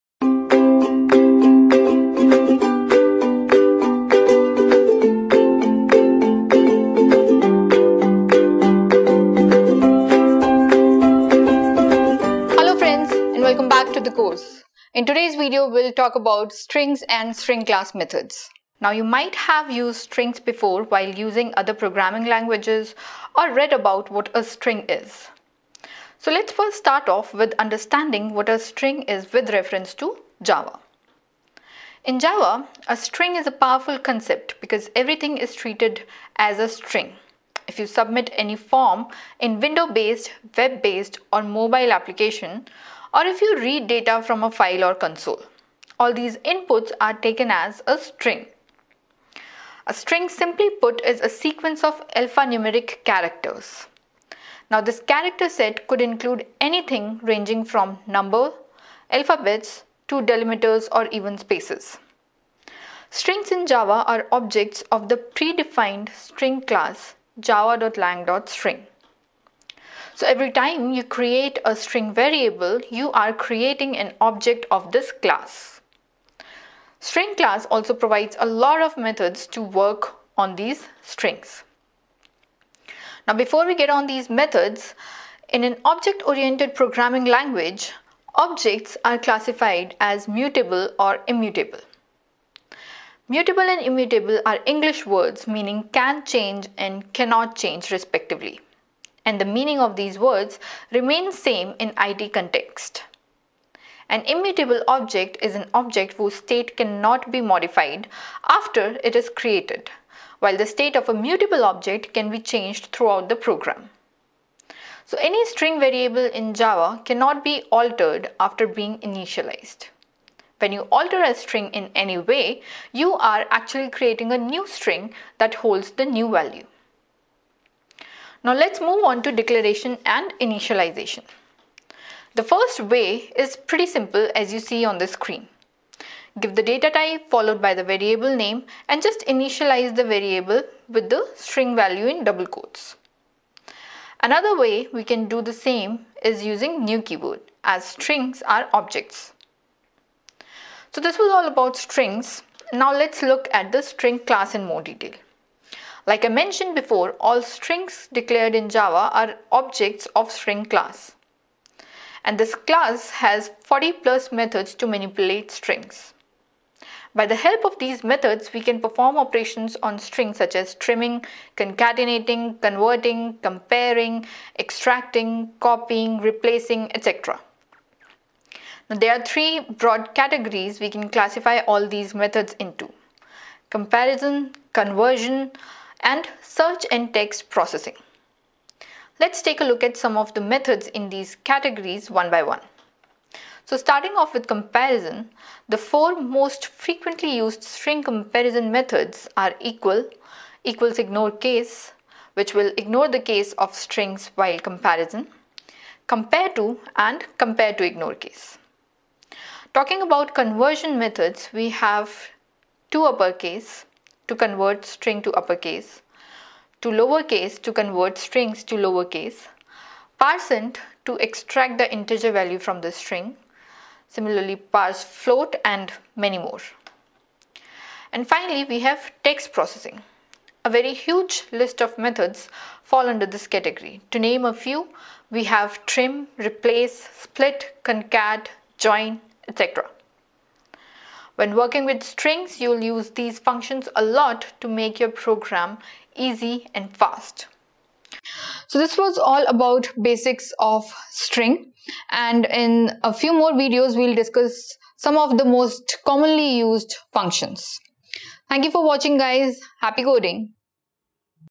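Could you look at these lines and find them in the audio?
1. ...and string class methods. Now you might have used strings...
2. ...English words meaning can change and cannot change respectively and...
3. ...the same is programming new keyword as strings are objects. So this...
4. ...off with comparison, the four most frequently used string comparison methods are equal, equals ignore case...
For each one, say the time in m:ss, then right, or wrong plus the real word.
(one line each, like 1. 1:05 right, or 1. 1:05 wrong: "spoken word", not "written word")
1. 0:17 right
2. 1:34 right
3. 2:25 wrong: "using", not "programming"
4. 3:14 right.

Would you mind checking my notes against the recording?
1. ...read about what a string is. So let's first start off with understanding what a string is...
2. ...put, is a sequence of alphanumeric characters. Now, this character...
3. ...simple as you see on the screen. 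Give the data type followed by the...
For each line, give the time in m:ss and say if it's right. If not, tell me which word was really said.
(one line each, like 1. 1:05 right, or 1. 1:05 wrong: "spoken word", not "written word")
1. 0:23 right
2. 0:50 right
3. 2:13 right.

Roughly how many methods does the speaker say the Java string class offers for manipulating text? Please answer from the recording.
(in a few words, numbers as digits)
40 plus.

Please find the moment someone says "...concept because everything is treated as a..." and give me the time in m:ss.
0:33.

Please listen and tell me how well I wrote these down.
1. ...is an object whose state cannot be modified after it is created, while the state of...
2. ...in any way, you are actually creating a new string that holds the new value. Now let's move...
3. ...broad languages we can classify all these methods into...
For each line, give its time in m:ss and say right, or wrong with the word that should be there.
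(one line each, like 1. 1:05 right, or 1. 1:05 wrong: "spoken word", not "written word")
1. 1:45 right
2. 2:01 right
3. 2:59 wrong: "categories", not "languages".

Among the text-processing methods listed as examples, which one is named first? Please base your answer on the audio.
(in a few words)
trim.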